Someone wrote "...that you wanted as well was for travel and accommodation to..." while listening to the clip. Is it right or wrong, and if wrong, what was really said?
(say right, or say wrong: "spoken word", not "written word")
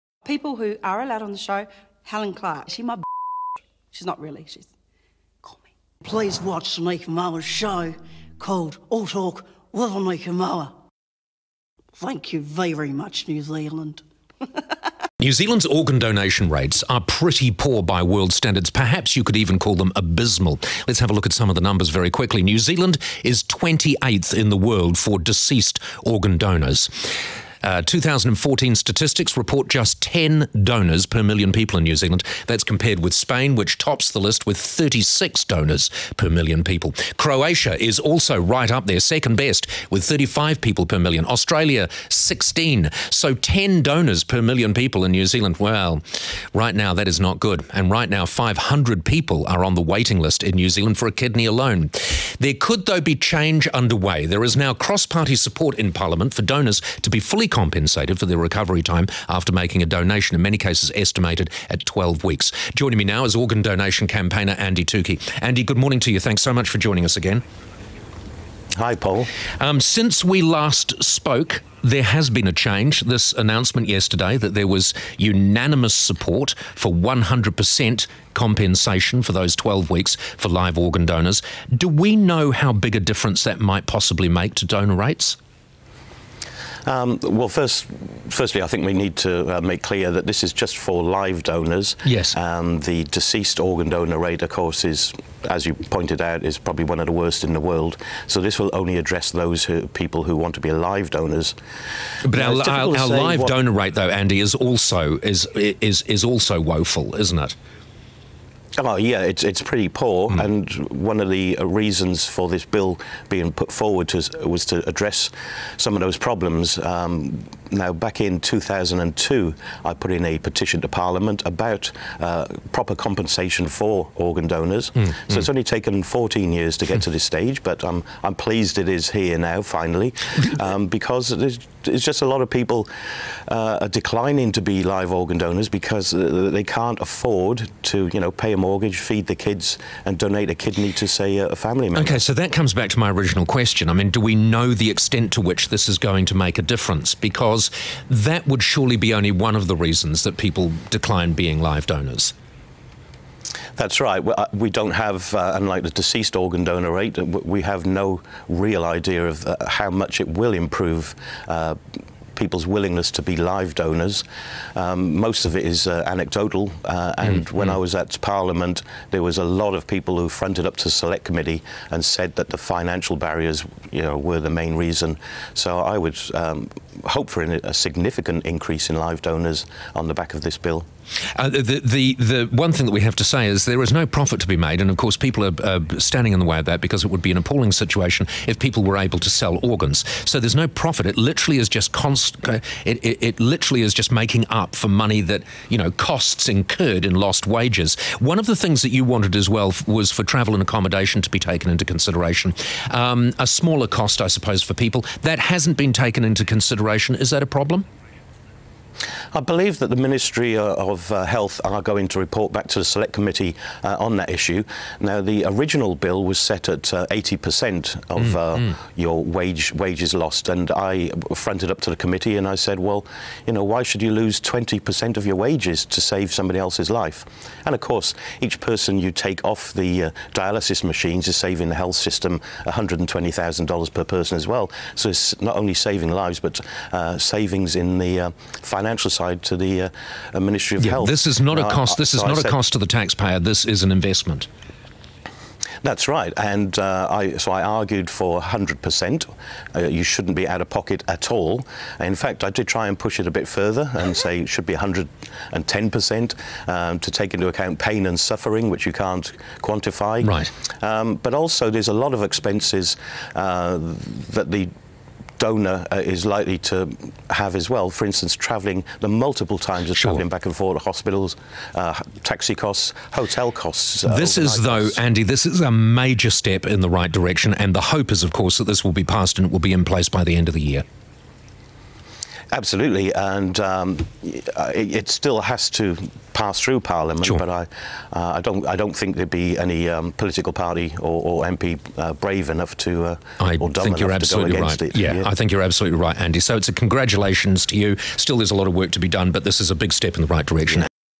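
right.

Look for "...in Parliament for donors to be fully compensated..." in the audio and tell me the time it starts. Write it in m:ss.
0:55.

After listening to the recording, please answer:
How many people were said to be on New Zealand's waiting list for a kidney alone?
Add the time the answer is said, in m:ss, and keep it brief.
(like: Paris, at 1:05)
500, at 0:48.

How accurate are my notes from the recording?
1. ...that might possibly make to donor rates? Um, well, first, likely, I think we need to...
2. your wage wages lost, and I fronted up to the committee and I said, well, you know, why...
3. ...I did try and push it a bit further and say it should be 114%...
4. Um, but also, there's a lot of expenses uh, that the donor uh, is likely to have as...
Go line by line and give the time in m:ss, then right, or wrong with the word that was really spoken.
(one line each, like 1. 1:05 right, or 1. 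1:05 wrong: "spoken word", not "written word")
1. 1:23 wrong: "firstly", not "likely"
2. 3:38 right
3. 4:12 wrong: "110", not "114"
4. 4:20 right.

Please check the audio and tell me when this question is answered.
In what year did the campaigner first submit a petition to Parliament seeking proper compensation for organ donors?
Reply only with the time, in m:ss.
1:58.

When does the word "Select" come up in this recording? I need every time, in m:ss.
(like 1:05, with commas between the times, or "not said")
2:50, 3:32.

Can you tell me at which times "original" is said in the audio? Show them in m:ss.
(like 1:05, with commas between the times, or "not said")
2:23, 3:35.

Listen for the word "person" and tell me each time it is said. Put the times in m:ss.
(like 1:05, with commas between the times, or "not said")
3:48, 3:54.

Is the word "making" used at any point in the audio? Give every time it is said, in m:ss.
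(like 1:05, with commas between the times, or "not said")
0:59, 3:14.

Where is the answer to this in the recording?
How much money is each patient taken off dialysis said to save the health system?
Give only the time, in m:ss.
3:52.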